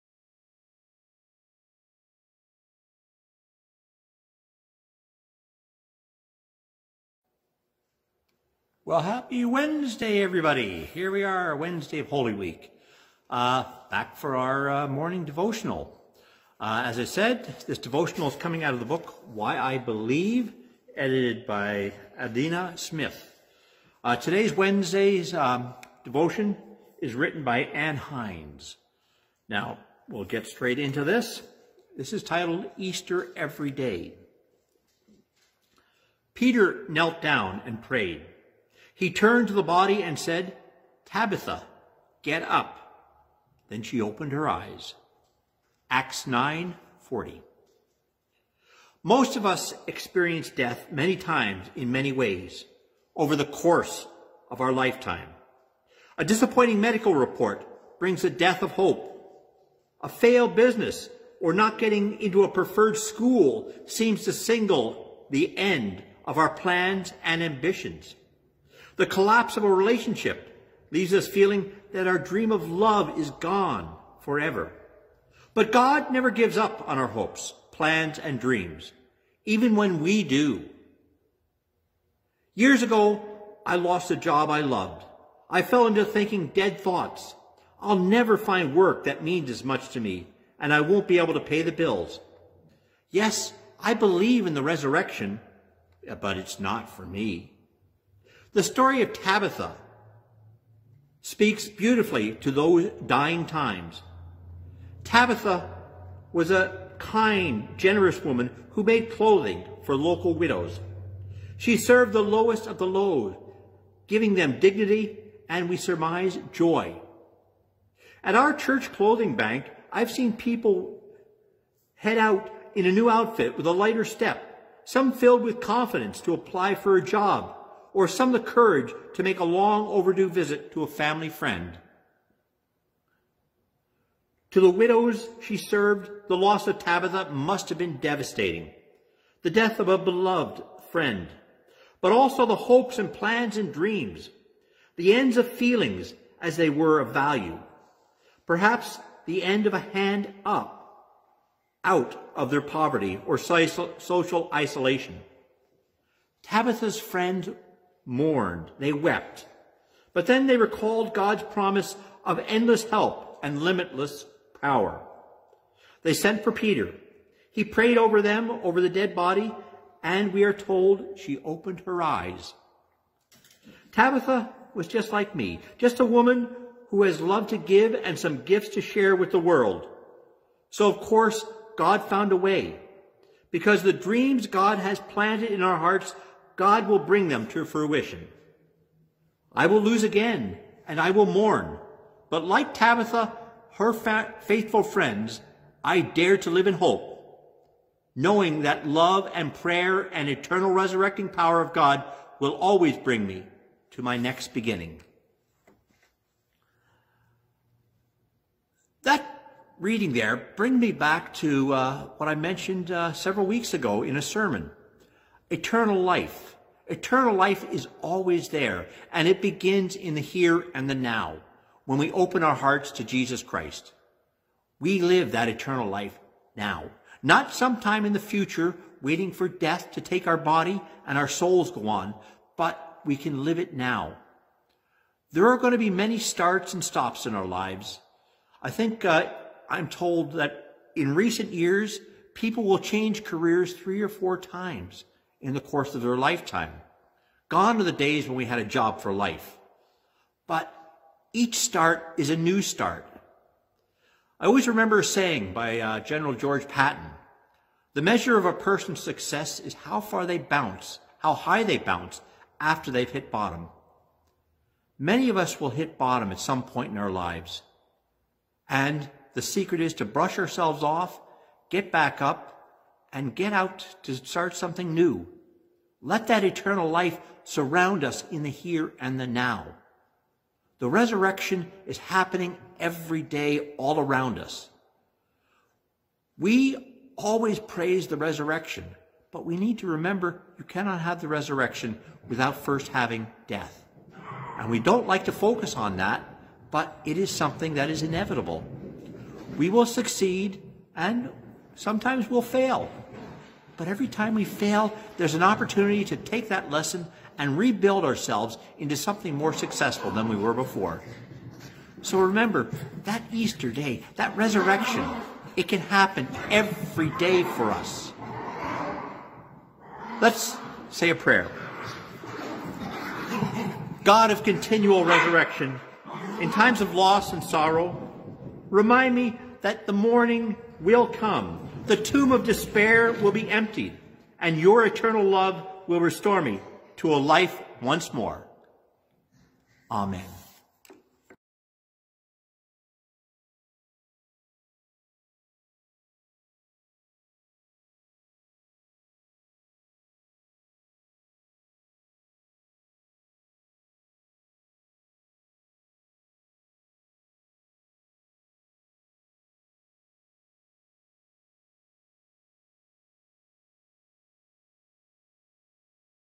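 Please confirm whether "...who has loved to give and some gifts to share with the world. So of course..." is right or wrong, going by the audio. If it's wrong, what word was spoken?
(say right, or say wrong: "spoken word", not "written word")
right.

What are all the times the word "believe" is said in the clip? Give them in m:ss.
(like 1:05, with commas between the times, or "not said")
0:19, 1:33.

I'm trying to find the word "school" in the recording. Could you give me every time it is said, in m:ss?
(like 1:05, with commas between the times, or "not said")
1:02.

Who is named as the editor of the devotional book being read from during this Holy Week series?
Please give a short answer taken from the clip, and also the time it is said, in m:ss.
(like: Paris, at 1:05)
Adina Smith, at 0:22.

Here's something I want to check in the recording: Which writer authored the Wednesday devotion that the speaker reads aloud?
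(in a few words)
Anne Hines.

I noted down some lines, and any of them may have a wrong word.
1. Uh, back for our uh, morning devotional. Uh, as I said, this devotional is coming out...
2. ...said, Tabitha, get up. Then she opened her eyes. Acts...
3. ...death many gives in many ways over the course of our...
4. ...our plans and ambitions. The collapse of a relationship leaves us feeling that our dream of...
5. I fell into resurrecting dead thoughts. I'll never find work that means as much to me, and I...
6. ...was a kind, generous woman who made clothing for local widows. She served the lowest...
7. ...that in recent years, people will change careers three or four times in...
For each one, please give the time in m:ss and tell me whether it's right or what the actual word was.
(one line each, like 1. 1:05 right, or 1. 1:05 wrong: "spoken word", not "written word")
1. 0:13 right
2. 0:40 right
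3. 0:50 wrong: "times", not "gives"
4. 1:06 right
5. 1:25 wrong: "thinking", not "resurrecting"
6. 1:46 right
7. 4:00 right.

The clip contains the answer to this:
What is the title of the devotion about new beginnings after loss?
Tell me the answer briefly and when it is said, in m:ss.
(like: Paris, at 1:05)
Easter Every Day, at 0:32.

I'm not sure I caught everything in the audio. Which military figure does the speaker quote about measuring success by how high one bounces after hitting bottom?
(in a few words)
General George Patton.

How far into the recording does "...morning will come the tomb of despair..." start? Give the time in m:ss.
5:29.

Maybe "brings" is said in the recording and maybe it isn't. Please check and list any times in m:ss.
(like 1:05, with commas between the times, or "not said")
0:57, 3:06, 3:22, 3:30.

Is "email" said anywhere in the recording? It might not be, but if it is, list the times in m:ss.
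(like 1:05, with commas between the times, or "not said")
not said.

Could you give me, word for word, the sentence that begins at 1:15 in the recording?
But God never gives up on our hopes, plans, and dreams, even when we do.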